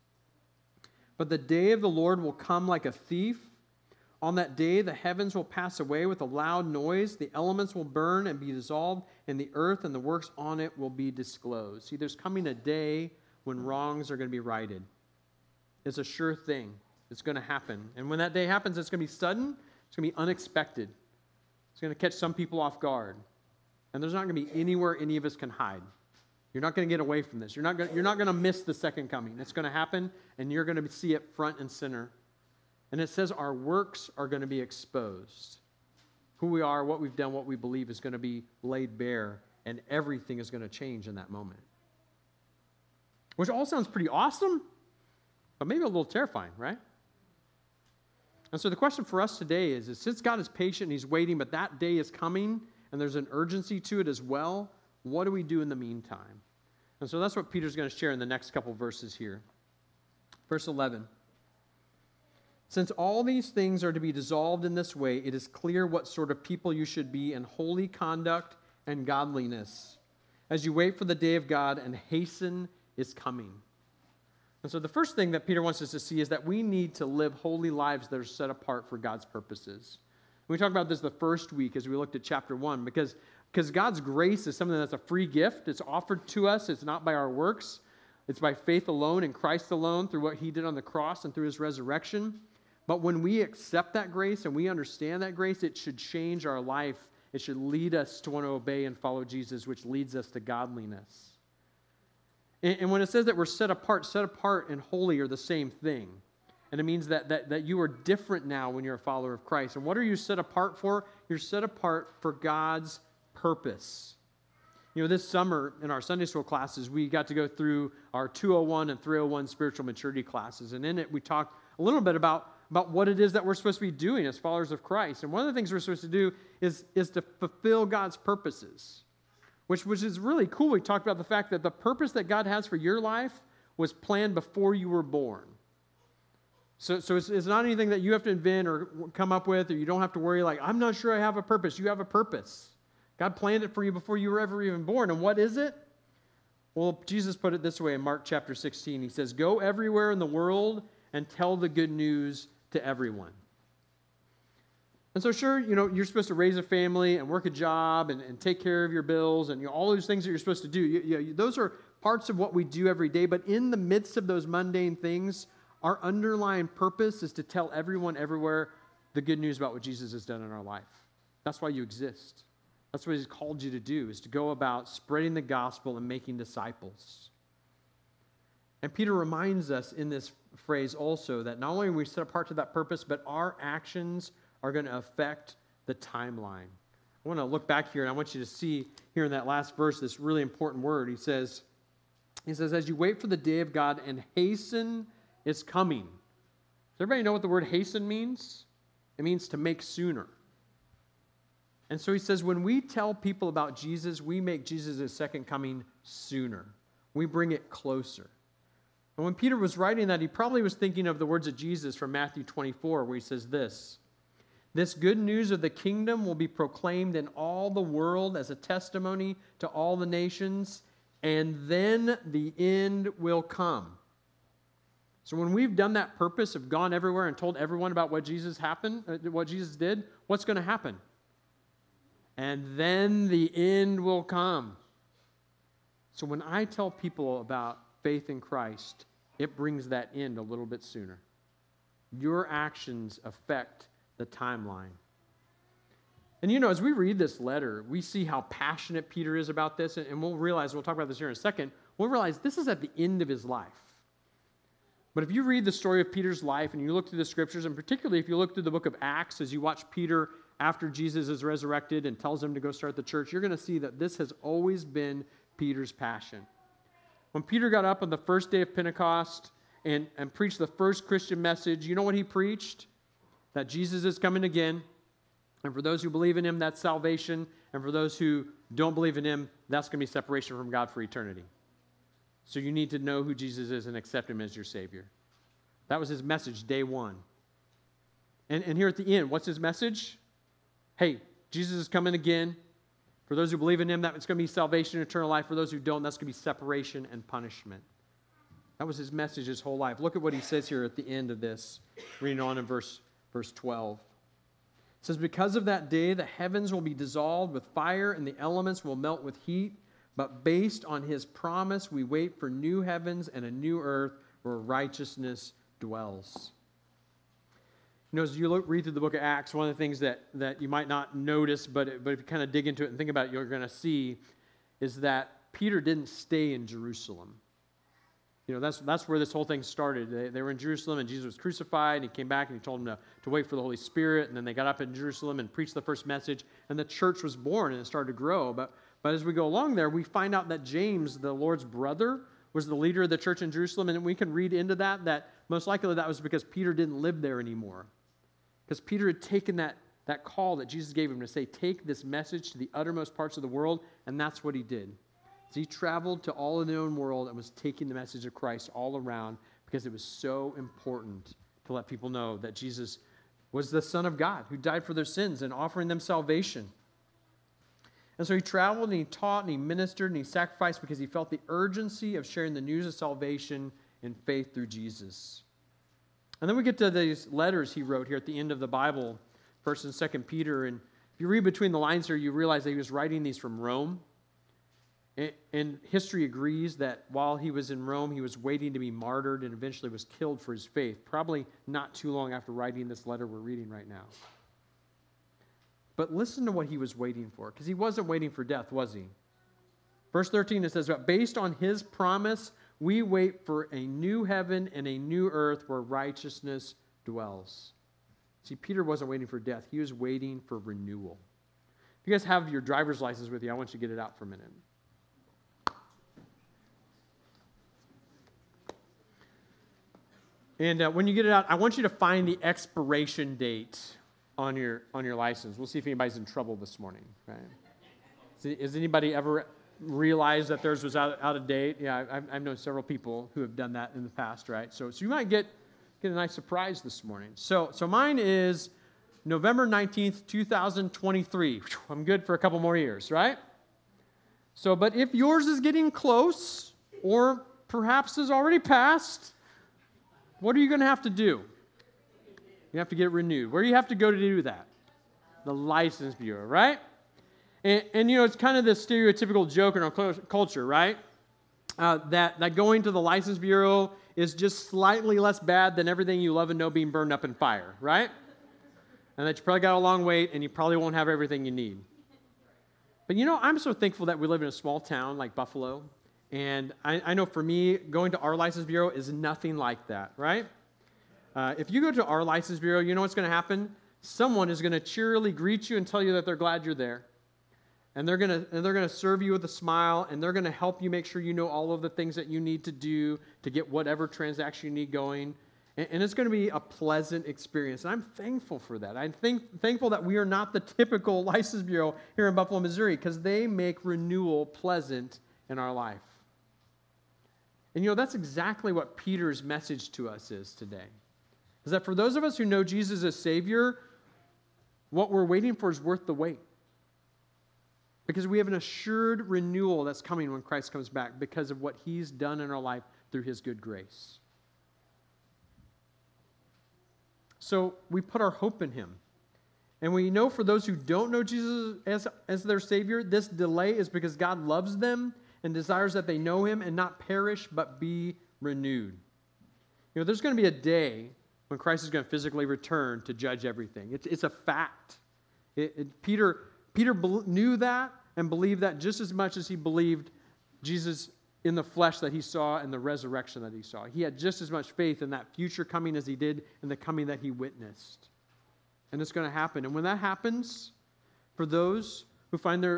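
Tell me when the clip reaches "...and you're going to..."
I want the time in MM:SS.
00:30.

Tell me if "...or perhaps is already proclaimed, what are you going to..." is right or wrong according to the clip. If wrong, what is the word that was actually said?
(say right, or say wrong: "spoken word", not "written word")
wrong: "passed", not "proclaimed".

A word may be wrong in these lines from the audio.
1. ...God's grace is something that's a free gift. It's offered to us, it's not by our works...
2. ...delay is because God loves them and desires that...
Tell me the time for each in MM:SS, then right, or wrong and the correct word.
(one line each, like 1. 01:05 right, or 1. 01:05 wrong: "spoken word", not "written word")
1. 01:23 right
2. 08:53 right.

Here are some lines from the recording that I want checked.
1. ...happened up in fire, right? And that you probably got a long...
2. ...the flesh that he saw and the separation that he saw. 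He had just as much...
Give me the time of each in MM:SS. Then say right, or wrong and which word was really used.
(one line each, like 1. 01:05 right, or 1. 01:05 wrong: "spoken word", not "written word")
1. 07:46 wrong: "burned", not "happened"
2. 09:11 wrong: "resurrection", not "separation".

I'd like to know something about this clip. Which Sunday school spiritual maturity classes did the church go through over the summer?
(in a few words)
201 and 301.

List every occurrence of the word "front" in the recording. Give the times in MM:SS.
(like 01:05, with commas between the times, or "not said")
00:31.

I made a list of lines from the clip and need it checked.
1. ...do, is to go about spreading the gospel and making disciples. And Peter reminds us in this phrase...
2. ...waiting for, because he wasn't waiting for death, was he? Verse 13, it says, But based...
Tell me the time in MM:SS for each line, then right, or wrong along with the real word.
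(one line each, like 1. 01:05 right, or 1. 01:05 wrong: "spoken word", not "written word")
1. 02:53 right
2. 06:36 right.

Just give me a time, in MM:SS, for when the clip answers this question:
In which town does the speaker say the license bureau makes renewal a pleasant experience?
08:22.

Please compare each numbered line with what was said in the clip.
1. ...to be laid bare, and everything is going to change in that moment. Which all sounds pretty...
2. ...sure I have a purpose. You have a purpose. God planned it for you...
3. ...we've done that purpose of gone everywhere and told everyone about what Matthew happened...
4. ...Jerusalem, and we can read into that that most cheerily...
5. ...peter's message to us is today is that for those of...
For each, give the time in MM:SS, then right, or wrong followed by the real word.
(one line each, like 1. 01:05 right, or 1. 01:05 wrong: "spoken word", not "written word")
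1. 00:38 right
2. 02:20 right
3. 03:45 wrong: "Jesus", not "Matthew"
4. 05:43 wrong: "likely", not "cheerily"
5. 08:28 right.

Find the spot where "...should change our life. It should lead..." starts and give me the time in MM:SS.
01:35.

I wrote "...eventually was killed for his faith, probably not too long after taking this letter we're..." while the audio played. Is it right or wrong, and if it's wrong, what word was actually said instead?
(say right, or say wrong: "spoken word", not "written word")
wrong: "writing", not "taking".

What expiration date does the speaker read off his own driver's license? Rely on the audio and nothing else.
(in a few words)
November 19, 2023.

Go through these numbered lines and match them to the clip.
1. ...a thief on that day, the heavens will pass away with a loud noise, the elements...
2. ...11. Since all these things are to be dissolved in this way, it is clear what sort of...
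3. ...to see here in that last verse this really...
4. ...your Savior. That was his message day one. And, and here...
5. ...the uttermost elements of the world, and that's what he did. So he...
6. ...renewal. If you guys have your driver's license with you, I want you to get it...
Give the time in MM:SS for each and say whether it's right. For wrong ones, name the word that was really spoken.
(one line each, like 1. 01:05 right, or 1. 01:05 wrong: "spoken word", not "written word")
1. 00:02 right
2. 01:00 right
3. 03:08 right
4. 04:44 right
5. 05:52 wrong: "parts", not "elements"
6. 06:50 right.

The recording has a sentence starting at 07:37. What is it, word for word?
And, and you know, it's kind of this stereotypical joke in our culture, right?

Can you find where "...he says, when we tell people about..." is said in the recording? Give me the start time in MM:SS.
03:22.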